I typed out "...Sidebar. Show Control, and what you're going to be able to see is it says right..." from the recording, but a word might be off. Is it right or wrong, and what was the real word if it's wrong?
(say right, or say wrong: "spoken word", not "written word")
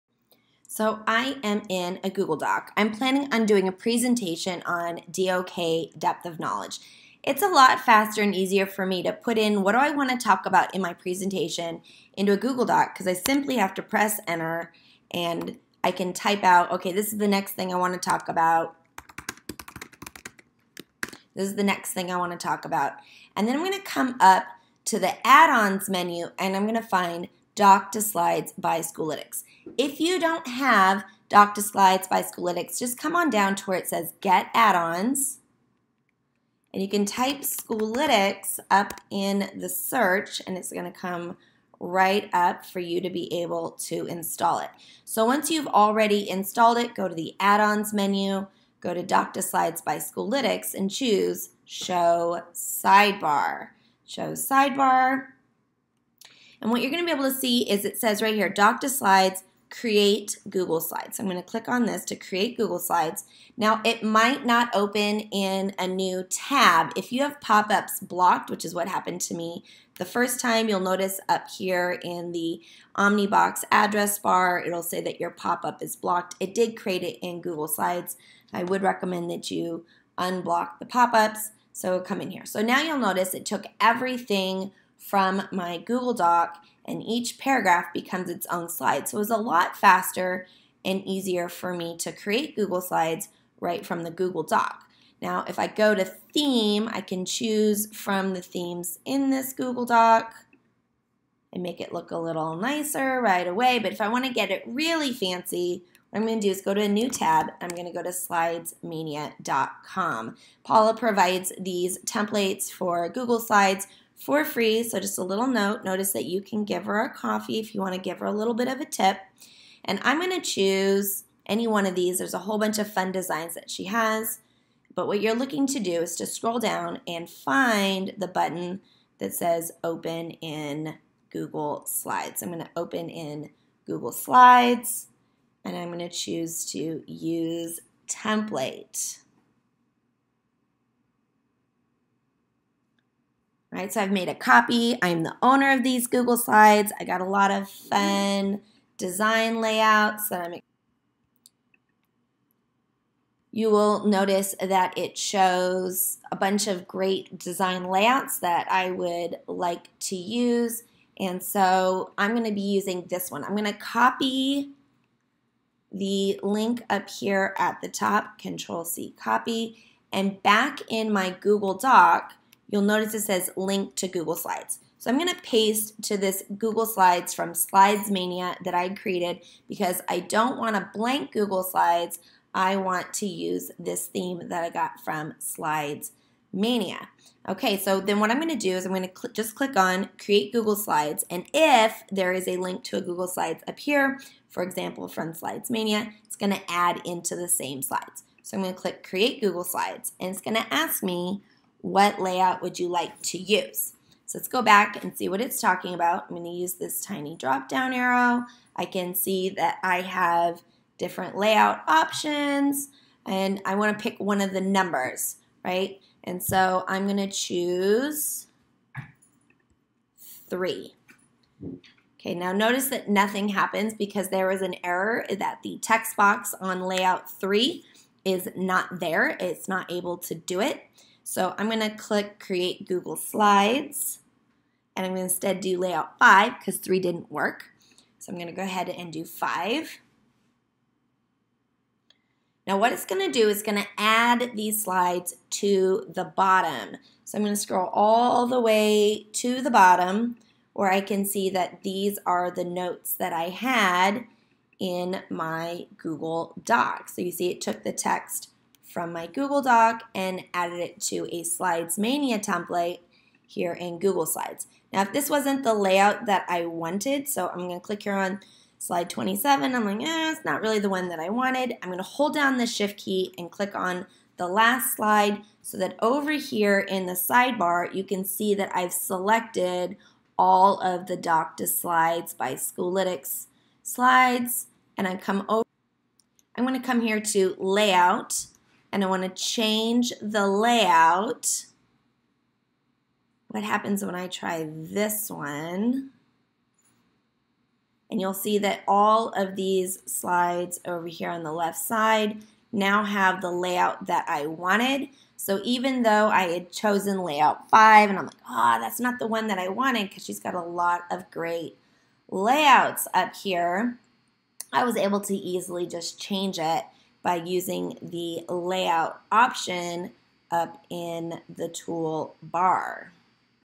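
wrong: "Sidebar", not "Control".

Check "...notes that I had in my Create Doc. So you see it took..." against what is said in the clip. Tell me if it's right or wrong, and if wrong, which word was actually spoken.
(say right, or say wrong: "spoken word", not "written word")
wrong: "Google", not "Create".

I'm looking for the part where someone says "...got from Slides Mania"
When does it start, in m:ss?
3:04.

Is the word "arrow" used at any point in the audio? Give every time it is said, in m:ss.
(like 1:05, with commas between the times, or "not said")
3:27.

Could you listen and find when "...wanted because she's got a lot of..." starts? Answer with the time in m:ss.
5:09.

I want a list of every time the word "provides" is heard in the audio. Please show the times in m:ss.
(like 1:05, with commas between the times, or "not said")
1:50.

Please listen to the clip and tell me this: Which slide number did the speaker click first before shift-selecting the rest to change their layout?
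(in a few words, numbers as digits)
27.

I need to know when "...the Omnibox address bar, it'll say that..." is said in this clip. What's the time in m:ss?
1:12.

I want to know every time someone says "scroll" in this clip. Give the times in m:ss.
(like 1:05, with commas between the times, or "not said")
2:06, 4:07.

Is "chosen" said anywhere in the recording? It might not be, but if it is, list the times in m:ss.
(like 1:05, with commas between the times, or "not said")
5:06.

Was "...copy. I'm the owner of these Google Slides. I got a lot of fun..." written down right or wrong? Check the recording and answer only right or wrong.
right.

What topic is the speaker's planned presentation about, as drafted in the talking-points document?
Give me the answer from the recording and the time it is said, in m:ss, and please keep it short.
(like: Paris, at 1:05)
Depth of knowledge, at 0:05.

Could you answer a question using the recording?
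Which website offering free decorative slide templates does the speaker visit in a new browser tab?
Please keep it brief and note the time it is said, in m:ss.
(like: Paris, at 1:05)
slidesmania.com, at 1:48.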